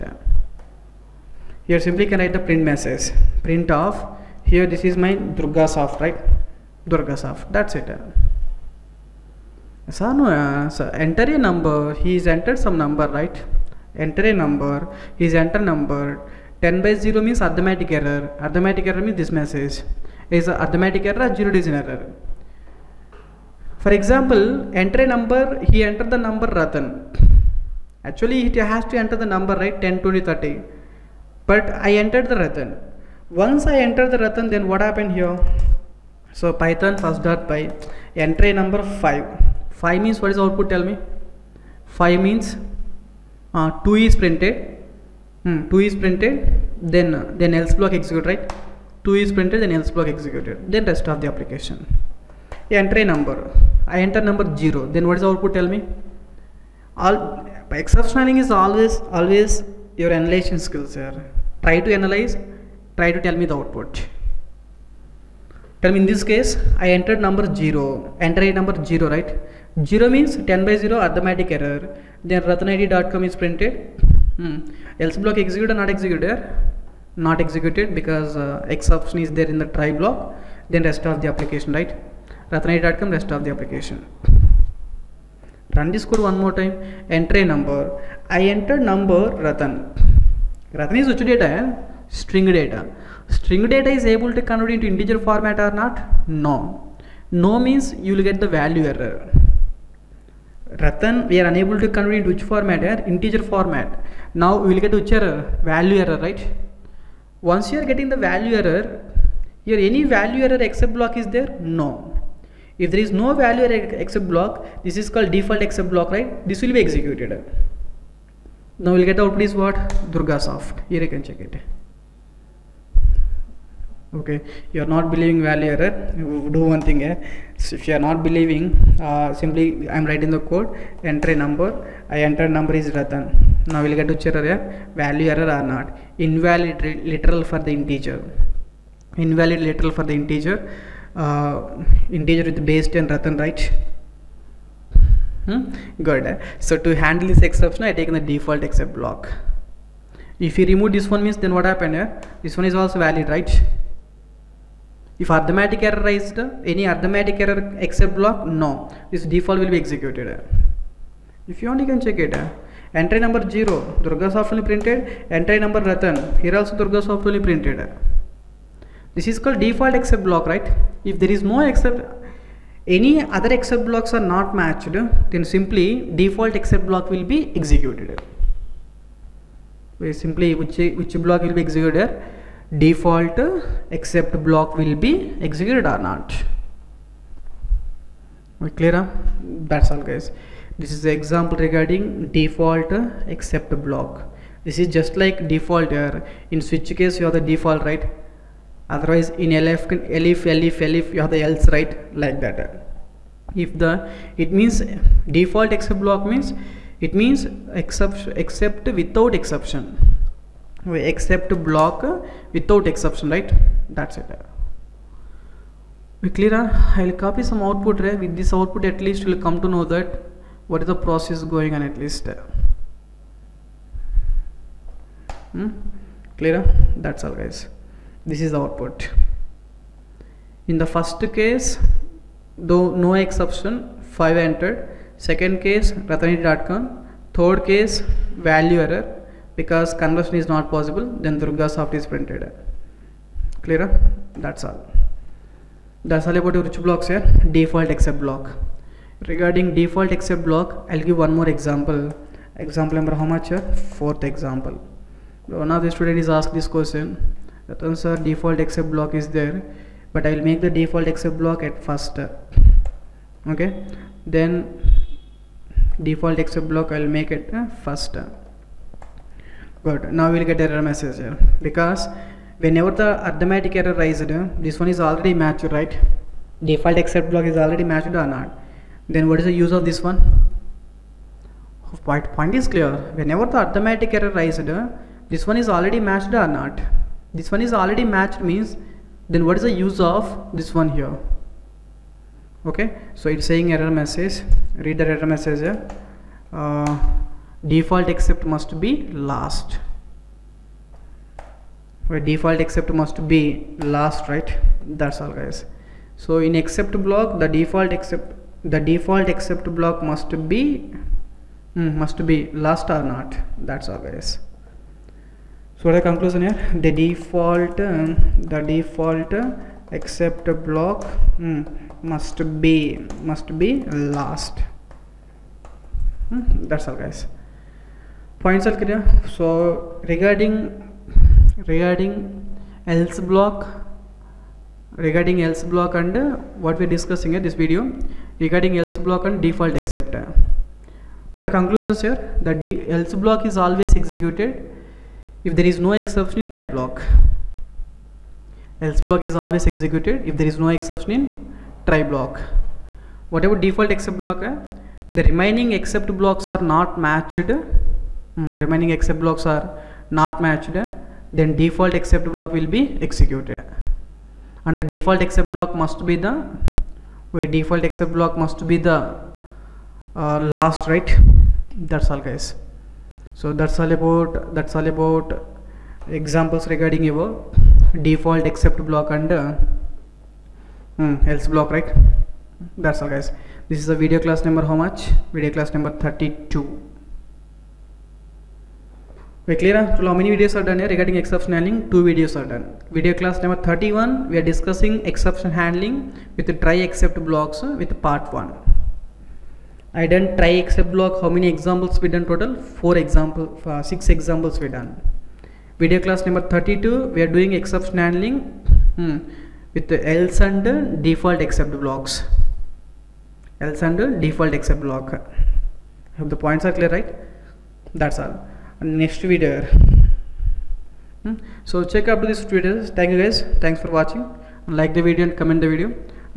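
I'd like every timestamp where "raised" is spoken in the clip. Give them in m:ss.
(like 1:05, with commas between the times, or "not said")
2:36, 4:33, 4:44.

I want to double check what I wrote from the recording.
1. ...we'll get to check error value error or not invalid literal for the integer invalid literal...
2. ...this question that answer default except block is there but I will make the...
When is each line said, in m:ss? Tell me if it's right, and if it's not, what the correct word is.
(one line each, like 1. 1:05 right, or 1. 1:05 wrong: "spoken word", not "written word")
1. 2:13 right
2. 4:16 right.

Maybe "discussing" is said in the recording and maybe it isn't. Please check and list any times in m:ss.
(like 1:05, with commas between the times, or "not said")
5:36, 6:34.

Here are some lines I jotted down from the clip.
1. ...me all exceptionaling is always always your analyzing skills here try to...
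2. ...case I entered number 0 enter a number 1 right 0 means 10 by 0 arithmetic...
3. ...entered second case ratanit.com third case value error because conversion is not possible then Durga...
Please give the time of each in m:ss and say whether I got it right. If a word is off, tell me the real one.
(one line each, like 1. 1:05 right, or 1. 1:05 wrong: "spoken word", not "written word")
1. 0:55 right
2. 1:06 wrong: "0", not "1"
3. 3:54 right.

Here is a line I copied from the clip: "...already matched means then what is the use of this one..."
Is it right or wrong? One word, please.
right.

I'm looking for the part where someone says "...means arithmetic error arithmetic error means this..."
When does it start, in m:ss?
0:17.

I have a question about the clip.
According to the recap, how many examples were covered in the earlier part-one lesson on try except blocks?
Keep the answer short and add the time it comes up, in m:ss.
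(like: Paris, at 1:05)
6, at 6:43.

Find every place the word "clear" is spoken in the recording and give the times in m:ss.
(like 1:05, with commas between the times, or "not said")
3:08, 3:36, 3:46, 4:03, 4:42, 5:28, 6:29, 6:56.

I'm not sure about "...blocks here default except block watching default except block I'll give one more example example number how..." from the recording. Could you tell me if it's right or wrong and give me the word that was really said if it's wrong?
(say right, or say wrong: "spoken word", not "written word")
wrong: "regarding", not "watching".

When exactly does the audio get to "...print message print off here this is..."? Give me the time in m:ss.
0:02.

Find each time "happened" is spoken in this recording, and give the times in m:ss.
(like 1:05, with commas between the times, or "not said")
0:34, 2:31.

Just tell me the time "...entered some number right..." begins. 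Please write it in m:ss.
0:12.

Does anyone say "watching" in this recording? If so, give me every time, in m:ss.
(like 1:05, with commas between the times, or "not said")
7:03.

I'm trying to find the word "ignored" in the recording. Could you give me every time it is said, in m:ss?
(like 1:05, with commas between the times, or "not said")
not said.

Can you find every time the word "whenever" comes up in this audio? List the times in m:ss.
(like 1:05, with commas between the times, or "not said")
4:32, 4:43.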